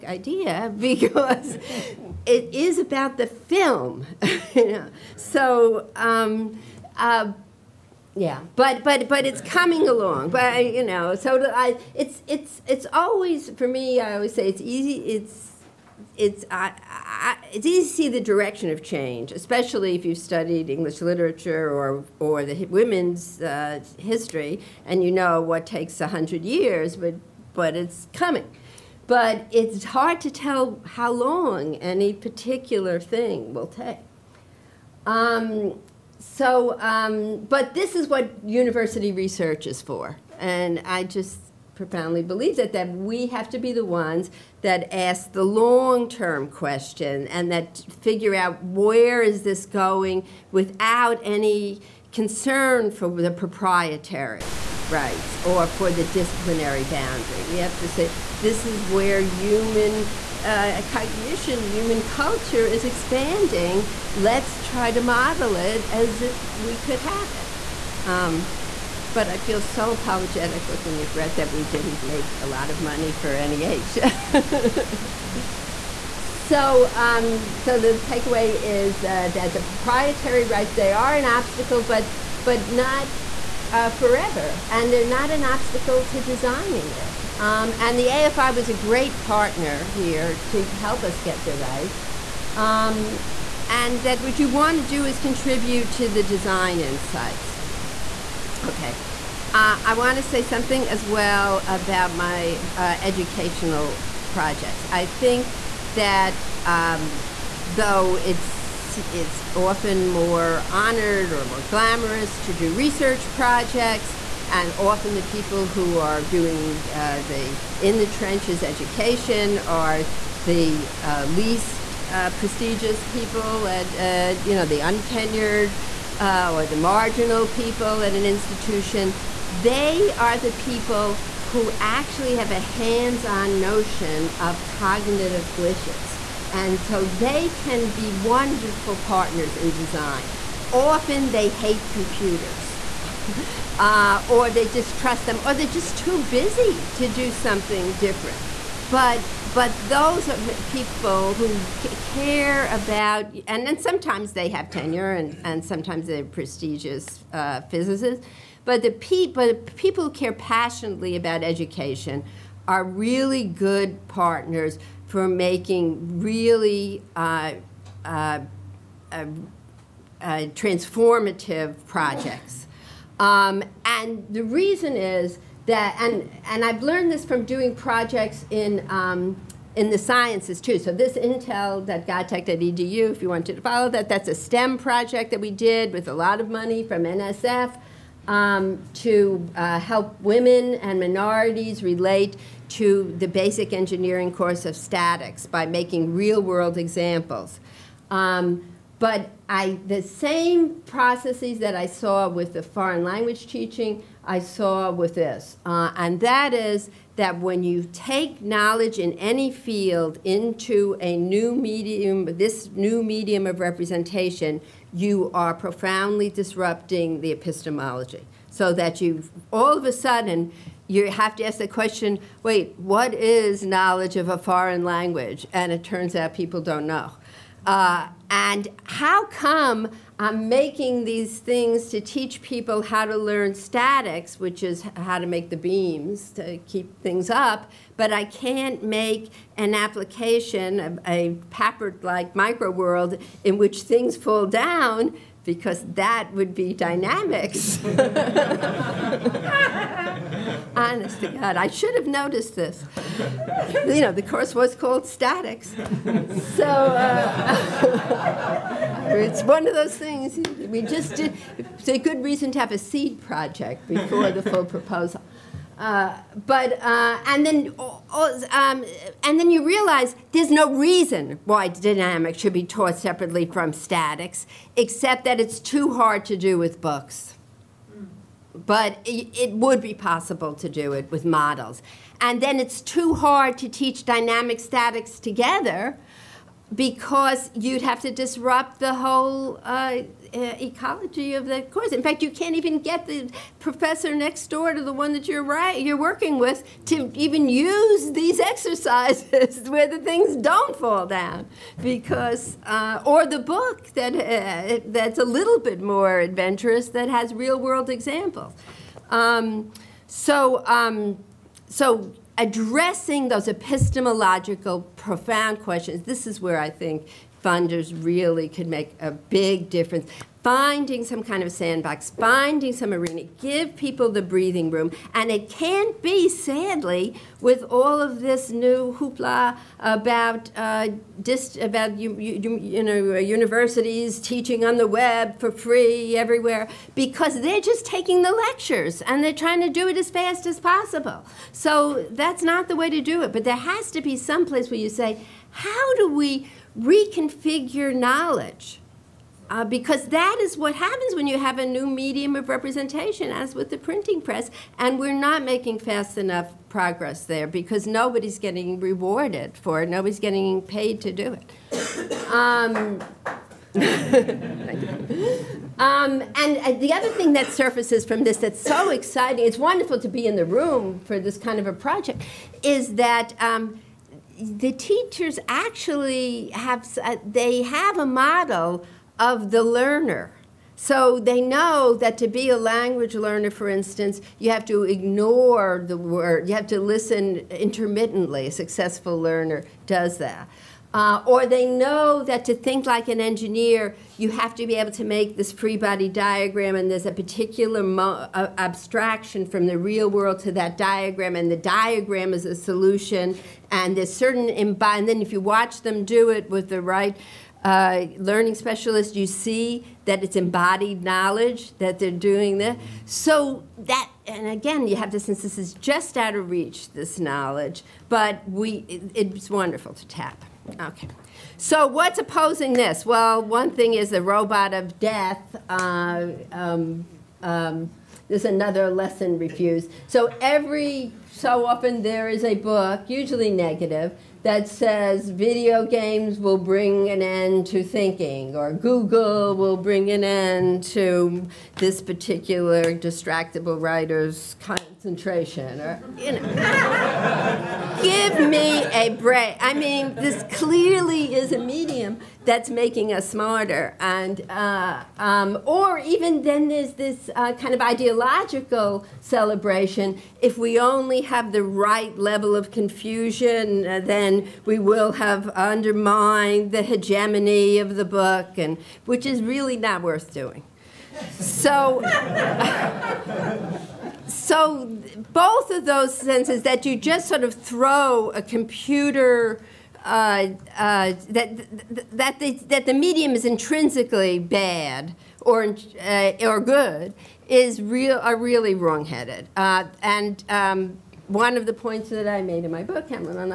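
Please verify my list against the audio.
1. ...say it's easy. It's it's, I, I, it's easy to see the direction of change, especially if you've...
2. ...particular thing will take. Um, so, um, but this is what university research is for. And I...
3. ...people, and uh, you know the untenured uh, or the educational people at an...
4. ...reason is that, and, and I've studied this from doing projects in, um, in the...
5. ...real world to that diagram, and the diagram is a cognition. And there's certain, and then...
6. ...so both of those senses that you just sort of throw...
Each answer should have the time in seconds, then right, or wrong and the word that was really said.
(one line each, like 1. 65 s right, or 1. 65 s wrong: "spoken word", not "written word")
1. 14 s right
2. 32 s right
3. 123 s wrong: "marginal", not "educational"
4. 174 s wrong: "learned", not "studied"
5. 399 s wrong: "solution", not "cognition"
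6. 474 s right.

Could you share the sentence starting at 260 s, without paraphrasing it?
We just did, it's a good reason to have a seed project before the full proposal.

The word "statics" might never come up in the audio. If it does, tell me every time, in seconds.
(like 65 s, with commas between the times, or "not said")
194 s, 233 s, 255 s, 273 s, 284 s.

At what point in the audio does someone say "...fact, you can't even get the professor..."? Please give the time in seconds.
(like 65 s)
292 s.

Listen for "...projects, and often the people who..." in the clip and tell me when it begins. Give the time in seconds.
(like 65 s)
113 s.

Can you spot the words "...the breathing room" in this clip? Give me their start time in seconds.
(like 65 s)
324 s.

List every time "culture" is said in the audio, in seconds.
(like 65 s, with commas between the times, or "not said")
62 s.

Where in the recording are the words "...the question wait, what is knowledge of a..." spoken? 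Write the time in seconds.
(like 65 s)
221 s.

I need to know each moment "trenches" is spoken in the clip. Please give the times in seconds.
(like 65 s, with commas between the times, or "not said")
118 s.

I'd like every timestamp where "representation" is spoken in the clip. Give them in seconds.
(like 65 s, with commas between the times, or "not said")
213 s, 352 s.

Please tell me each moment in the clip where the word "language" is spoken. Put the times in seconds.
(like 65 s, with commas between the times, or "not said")
203 s, 224 s, 382 s.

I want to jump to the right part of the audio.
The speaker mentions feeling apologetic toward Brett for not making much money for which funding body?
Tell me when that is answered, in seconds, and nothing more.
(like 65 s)
73 s.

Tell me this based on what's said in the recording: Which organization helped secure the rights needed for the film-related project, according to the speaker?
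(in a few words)
AFI.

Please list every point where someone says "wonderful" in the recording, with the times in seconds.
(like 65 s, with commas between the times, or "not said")
138 s, 369 s, 419 s.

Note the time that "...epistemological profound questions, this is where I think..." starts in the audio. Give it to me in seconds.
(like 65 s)
313 s.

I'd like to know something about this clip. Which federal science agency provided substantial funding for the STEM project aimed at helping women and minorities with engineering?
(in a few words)
NSF.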